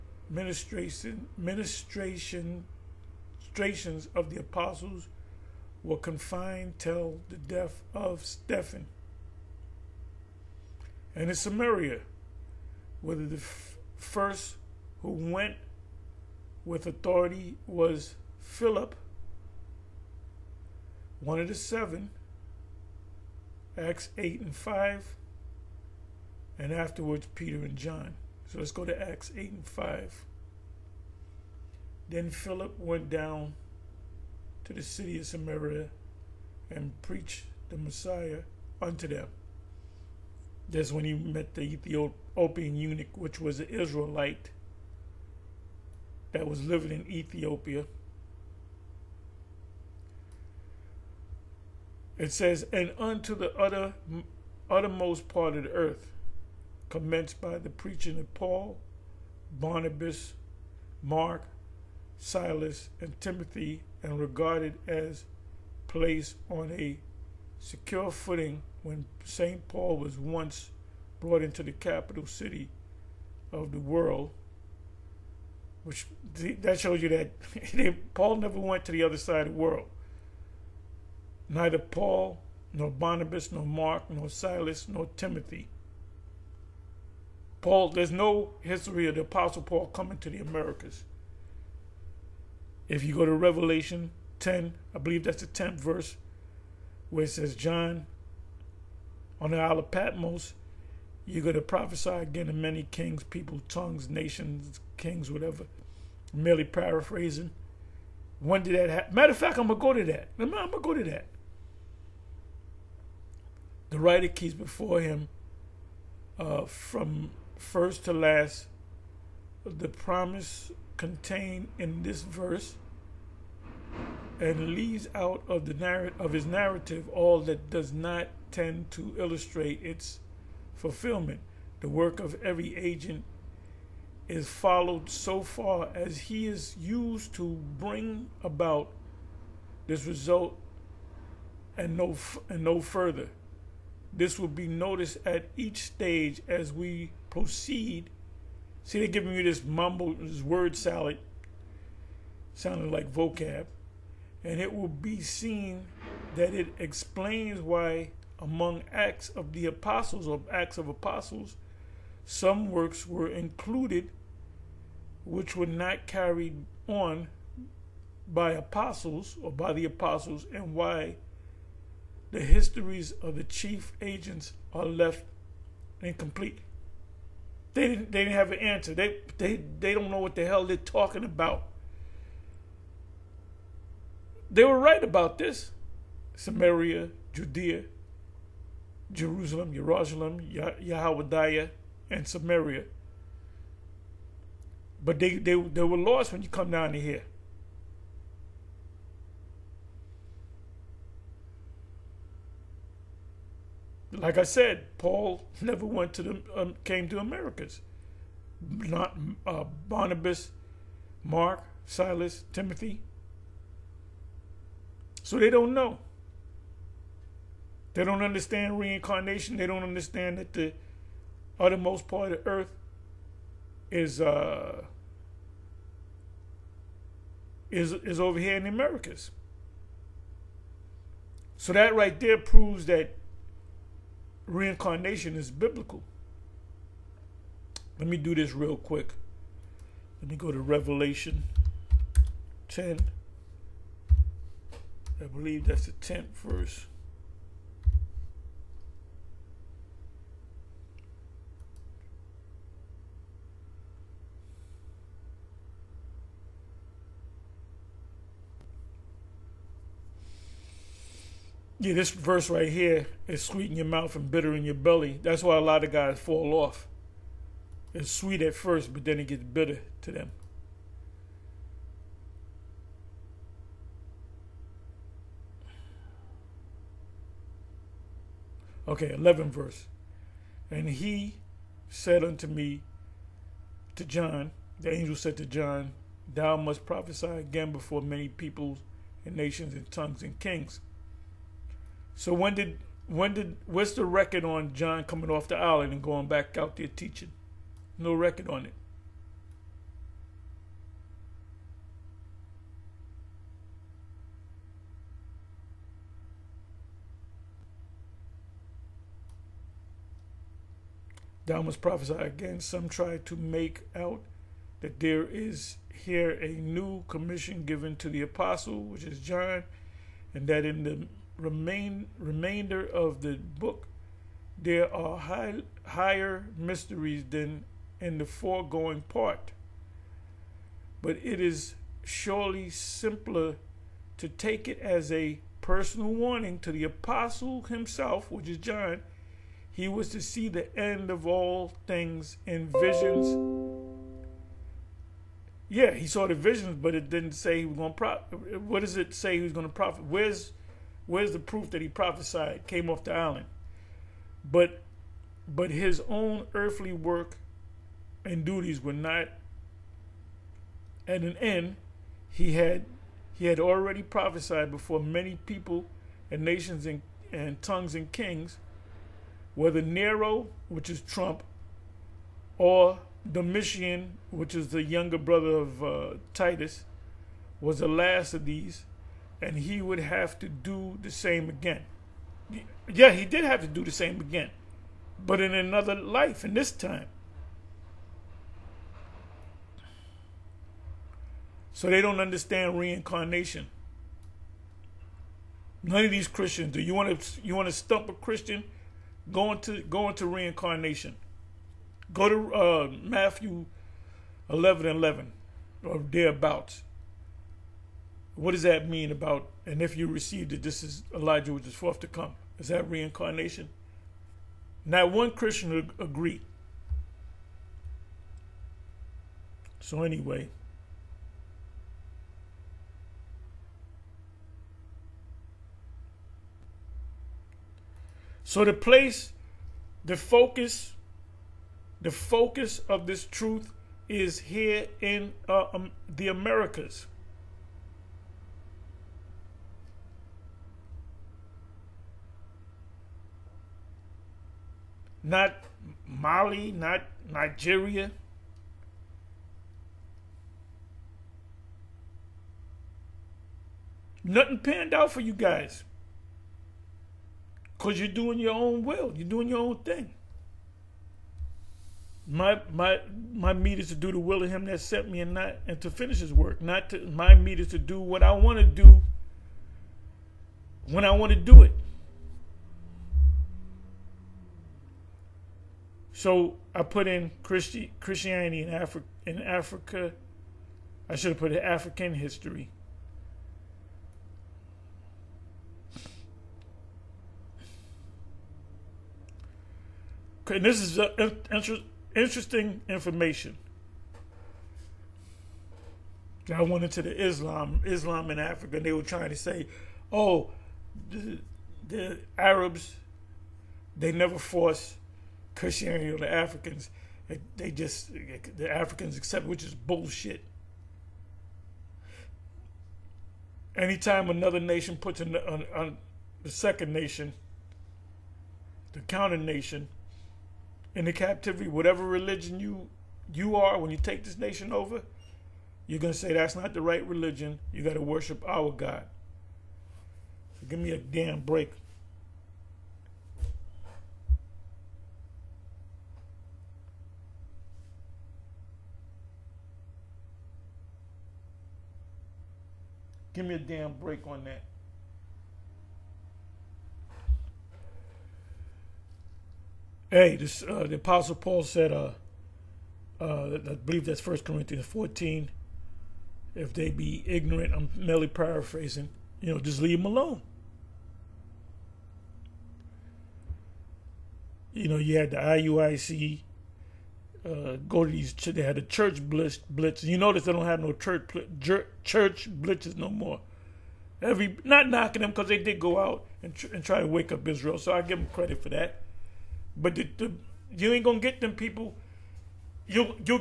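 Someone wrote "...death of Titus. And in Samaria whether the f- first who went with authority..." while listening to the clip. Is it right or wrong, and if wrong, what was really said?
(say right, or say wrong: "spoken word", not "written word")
wrong: "Stephen", not "Titus".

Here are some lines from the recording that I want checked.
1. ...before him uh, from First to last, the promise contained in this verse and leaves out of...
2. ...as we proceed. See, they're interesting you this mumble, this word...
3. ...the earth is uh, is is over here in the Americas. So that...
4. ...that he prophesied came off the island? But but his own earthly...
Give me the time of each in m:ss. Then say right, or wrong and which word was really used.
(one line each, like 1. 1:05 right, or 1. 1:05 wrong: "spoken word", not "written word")
1. 1:54 right
2. 2:26 wrong: "giving", not "interesting"
3. 3:42 right
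4. 5:51 right.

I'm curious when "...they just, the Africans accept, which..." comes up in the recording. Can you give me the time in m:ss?
8:27.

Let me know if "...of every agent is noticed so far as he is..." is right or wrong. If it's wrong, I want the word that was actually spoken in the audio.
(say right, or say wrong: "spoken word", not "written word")
wrong: "followed", not "noticed".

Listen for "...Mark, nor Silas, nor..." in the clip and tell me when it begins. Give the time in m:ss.
1:23.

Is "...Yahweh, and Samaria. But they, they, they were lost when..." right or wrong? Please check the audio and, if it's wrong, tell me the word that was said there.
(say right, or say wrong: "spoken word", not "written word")
right.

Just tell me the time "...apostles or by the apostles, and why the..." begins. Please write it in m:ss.
2:48.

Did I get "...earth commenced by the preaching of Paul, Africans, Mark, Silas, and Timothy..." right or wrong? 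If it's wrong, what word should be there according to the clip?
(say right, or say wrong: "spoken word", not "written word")
wrong: "Barnabas", not "Africans".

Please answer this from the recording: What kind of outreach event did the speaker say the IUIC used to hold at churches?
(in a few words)
Church blitz.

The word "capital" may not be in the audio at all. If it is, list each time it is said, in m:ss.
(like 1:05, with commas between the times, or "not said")
1:11.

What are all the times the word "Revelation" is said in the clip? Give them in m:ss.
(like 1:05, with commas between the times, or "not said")
1:33, 4:00.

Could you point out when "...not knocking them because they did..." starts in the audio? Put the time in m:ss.
9:34.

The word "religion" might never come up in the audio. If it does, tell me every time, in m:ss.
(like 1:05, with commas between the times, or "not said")
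8:42, 8:47.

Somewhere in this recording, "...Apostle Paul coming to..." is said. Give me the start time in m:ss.
1:29.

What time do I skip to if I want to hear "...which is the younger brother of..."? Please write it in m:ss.
6:14.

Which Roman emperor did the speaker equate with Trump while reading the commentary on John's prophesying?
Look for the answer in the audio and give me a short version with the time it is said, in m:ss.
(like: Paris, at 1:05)
Nero, at 6:09.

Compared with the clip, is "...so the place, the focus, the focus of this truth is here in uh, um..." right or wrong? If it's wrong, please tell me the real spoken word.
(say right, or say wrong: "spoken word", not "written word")
right.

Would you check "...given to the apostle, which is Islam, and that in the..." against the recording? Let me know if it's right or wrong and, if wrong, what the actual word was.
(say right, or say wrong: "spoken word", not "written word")
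wrong: "John", not "Islam".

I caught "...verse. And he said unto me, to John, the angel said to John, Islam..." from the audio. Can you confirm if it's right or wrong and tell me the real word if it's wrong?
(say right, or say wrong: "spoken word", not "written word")
wrong: "Thou", not "Islam".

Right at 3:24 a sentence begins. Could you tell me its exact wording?
like I said, Paul never went to the um, came to Americas.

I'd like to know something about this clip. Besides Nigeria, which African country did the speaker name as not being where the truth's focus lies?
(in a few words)
Mali.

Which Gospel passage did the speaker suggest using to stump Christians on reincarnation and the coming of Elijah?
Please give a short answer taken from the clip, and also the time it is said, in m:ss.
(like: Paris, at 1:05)
Matthew 11:11, at 6:43.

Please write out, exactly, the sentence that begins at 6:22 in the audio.
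Yeah, he did have to do the same again, but in another life, and this time.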